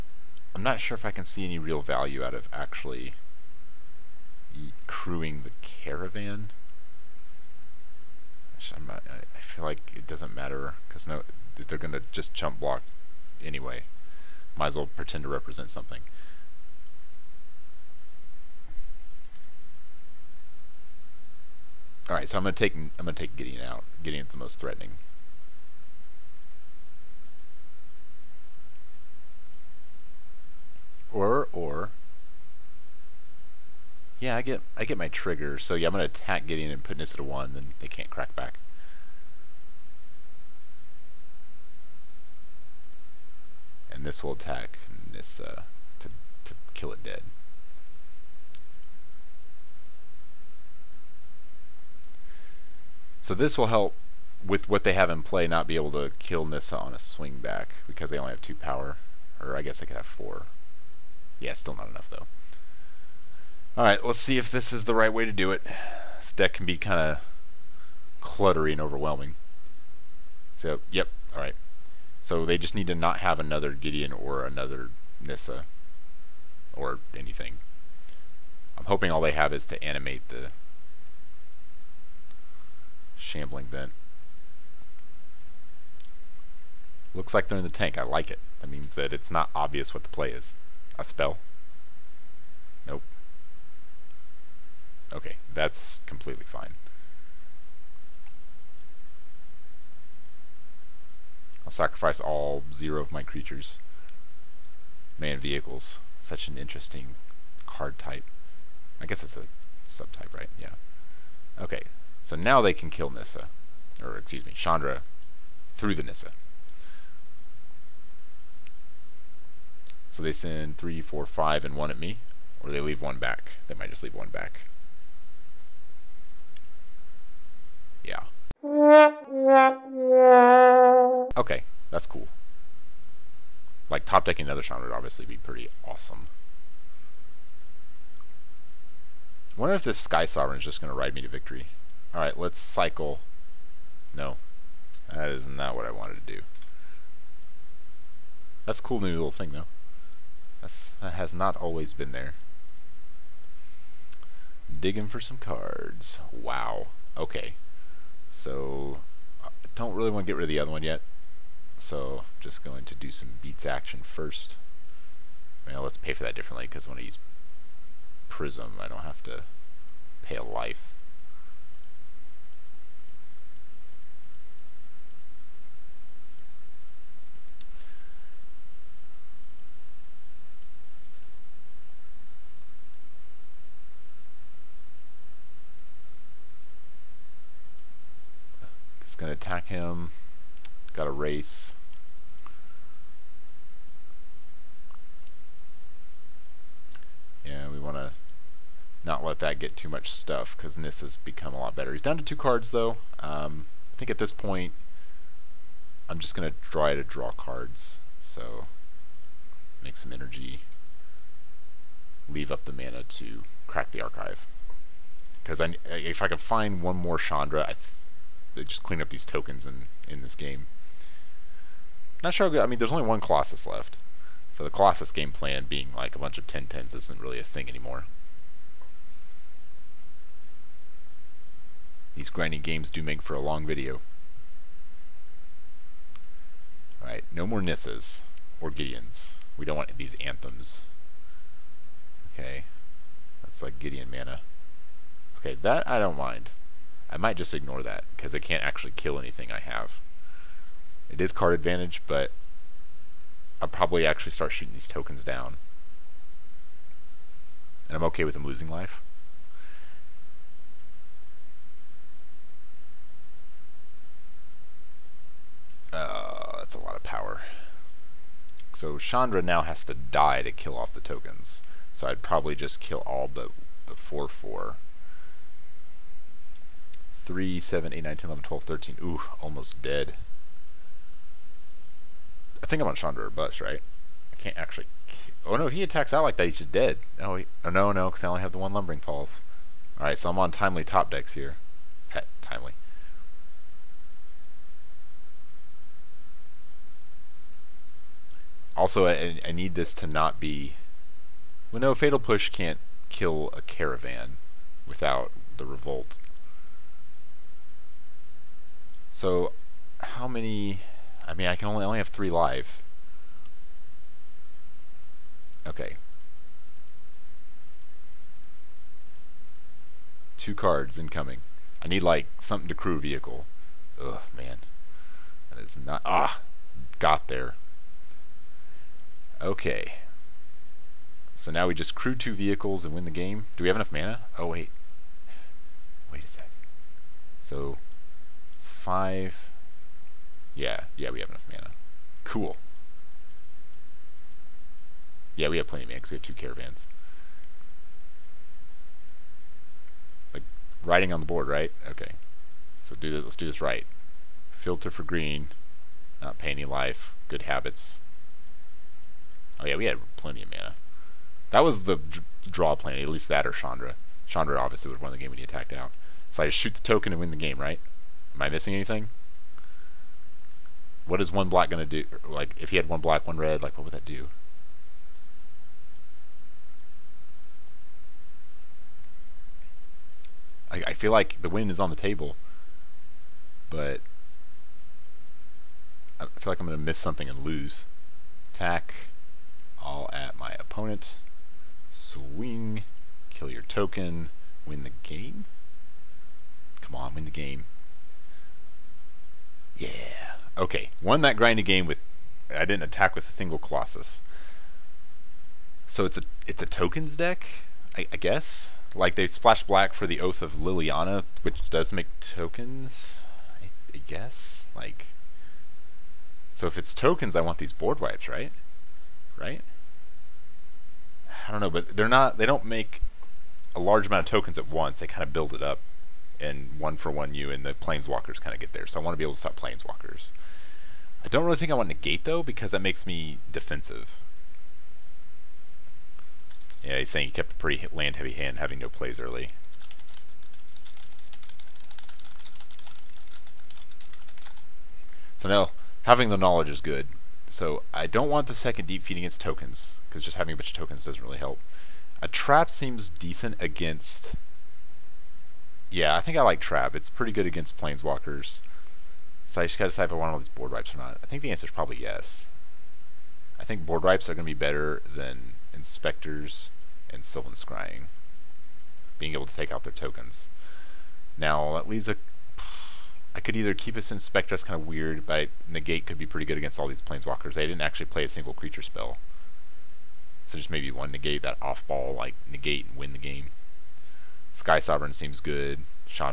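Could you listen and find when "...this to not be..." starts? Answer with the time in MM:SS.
04:59.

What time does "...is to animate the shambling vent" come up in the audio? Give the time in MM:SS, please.
01:19.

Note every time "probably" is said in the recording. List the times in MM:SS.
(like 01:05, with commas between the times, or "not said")
04:13, 04:32, 07:41.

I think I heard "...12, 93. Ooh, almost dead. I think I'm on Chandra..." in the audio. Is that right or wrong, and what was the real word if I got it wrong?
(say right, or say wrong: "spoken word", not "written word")
wrong: "13", not "93".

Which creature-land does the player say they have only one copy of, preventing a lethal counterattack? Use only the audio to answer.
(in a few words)
Lumbering Falls.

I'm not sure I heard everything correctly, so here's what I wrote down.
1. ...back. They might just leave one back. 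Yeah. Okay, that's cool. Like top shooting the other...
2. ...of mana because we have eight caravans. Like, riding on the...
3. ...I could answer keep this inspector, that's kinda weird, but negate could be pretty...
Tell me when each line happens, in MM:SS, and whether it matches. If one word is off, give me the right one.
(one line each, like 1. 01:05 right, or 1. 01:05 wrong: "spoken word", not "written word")
1. 02:03 wrong: "decking", not "shooting"
2. 05:45 wrong: "two", not "eight"
3. 07:53 wrong: "either", not "answer".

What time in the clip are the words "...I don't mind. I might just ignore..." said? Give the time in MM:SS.
04:05.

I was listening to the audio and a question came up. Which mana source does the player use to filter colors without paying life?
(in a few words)
Prism.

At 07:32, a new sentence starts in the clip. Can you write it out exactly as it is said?
A trap seems decent against yeah, I think I like Trap.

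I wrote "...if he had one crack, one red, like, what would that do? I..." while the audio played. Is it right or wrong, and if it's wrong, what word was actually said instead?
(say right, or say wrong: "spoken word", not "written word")
wrong: "black", not "crack".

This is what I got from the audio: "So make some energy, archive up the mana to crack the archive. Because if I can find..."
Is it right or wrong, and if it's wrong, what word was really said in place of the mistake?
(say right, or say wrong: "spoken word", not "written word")
wrong: "leave", not "archive".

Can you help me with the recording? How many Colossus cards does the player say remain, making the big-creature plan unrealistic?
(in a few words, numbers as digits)
1.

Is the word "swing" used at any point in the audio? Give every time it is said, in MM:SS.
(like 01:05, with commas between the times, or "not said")
00:56, 06:31.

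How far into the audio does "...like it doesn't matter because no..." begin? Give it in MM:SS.
00:09.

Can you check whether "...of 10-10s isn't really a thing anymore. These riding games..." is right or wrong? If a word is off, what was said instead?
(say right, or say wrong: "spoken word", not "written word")
wrong: "grinding", not "riding".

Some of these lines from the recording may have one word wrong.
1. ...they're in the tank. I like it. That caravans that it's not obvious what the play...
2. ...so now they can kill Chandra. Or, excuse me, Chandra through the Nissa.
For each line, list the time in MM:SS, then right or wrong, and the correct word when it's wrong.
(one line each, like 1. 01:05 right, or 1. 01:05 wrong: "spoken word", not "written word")
1. 01:27 wrong: "means", not "caravans"
2. 01:52 wrong: "Nissa", not "Chandra".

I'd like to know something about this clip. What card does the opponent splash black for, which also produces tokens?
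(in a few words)
Oath of Liliana.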